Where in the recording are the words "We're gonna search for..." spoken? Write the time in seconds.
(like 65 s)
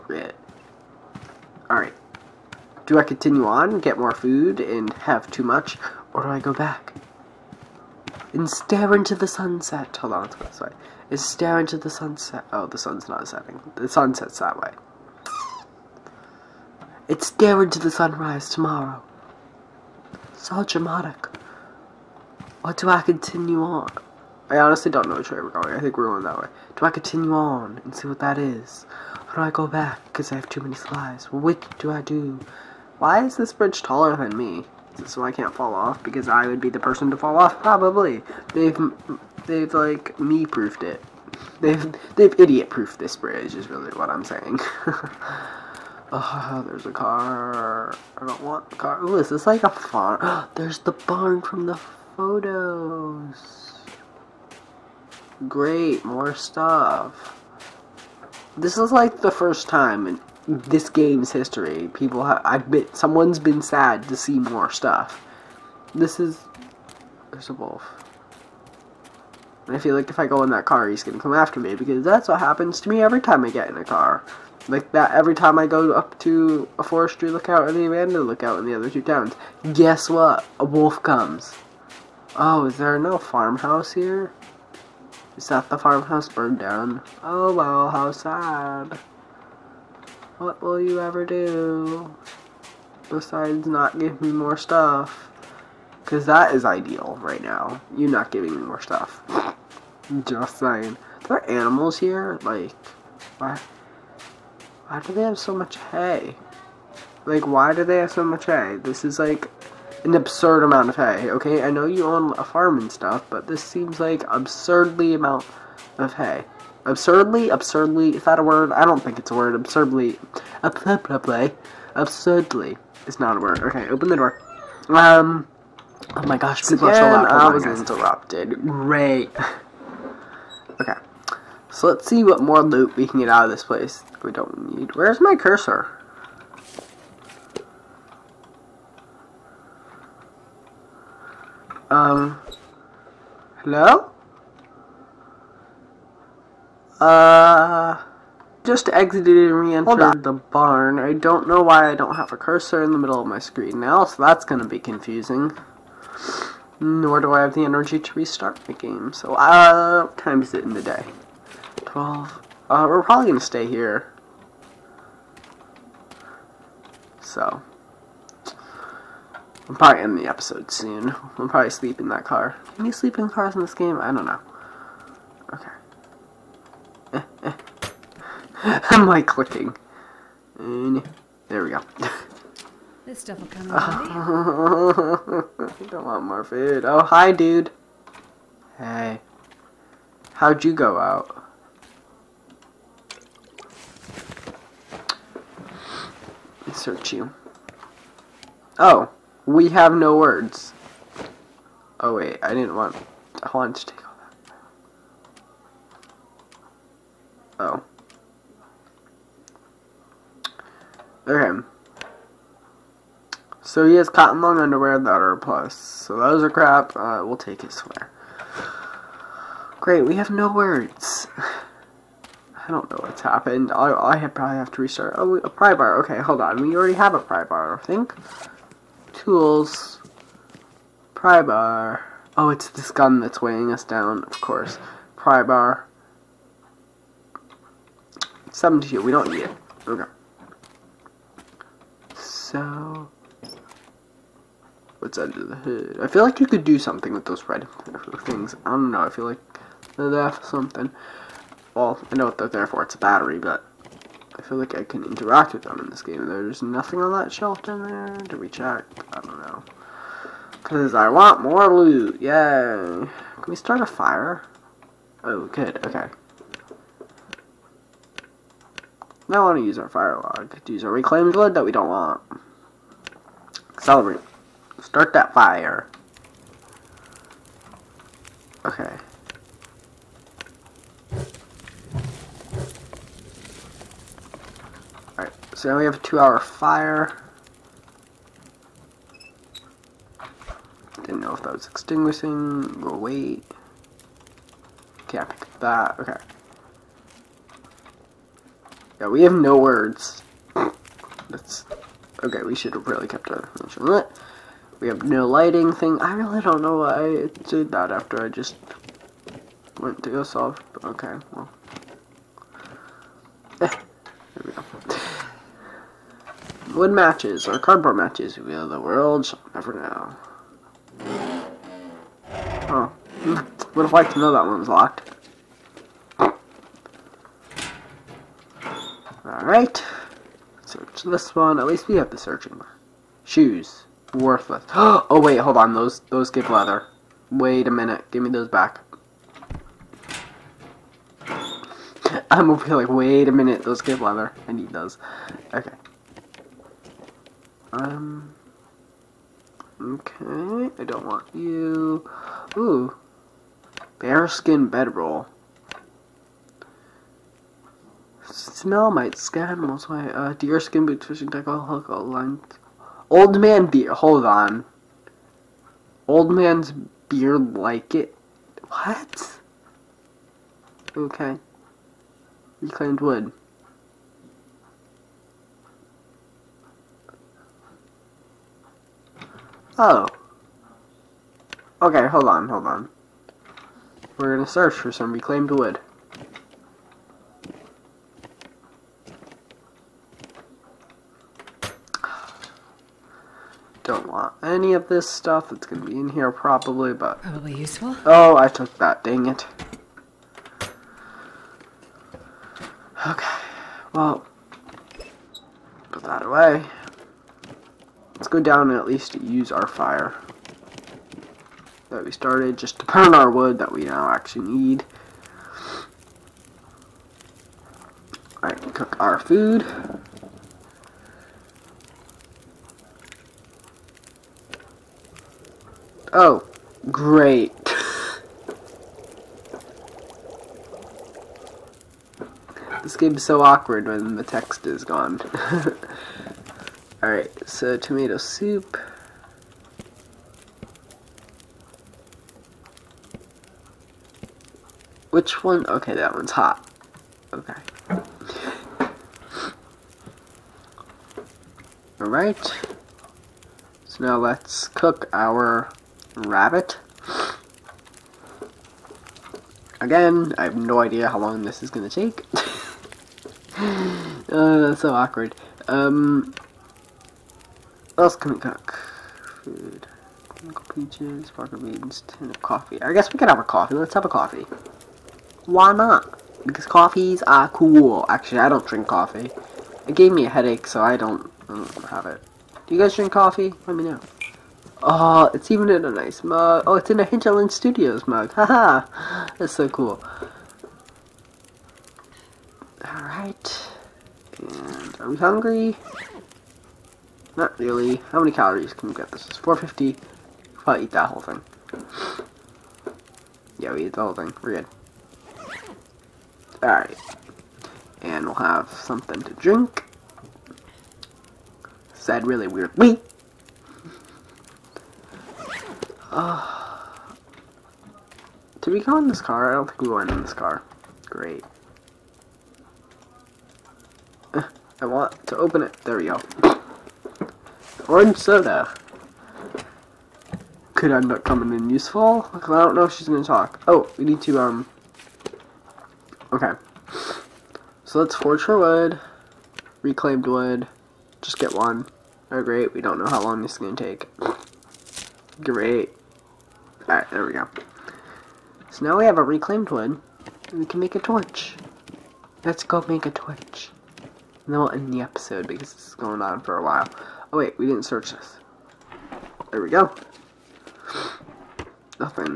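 384 s.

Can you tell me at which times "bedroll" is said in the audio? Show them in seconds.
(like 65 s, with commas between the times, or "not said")
354 s.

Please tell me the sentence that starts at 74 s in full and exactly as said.
Like that every time I go up to a forestry lookout and the abandoned lookout in the other two towns.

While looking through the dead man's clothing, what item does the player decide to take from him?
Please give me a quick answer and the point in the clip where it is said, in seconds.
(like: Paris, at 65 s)
His sweater, at 217 s.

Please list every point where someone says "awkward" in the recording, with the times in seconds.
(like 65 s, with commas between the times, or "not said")
433 s, 464 s.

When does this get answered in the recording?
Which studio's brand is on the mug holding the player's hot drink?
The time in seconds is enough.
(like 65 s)
487 s.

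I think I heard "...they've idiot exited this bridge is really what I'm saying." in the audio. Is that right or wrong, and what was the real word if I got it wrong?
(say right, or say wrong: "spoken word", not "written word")
wrong: "proofed", not "exited".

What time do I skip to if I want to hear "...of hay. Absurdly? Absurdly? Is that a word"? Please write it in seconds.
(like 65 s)
115 s.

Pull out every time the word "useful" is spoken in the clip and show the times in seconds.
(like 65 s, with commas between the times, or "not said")
397 s, 531 s.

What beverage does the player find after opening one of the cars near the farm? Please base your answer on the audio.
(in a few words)
Orange soda.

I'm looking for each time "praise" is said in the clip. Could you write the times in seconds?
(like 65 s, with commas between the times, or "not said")
not said.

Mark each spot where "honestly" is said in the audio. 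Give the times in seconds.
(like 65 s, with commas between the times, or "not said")
24 s.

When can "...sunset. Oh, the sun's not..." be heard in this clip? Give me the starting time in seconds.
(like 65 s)
11 s.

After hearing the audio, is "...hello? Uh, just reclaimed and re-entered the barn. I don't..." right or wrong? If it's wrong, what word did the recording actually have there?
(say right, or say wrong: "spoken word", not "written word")
wrong: "exited", not "reclaimed".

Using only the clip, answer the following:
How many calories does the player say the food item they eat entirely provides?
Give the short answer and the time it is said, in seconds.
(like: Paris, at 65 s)
450, at 499 s.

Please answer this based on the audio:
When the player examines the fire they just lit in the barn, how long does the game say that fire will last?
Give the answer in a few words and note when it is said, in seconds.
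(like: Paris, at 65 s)
2 hours, at 285 s.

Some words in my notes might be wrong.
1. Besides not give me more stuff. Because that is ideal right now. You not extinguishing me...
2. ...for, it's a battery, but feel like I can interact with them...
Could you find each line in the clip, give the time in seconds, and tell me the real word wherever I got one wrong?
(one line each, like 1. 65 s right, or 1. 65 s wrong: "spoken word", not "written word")
1. 93 s wrong: "giving", not "extinguishing"
2. 252 s right.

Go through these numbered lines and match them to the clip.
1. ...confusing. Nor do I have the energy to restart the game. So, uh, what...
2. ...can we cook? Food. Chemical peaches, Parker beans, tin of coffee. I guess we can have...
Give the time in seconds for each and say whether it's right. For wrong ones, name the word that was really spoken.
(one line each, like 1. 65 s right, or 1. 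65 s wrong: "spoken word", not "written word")
1. 154 s right
2. 468 s right.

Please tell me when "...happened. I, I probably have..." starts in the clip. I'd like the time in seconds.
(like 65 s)
223 s.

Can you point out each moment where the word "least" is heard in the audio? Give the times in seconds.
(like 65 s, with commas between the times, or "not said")
331 s, 408 s.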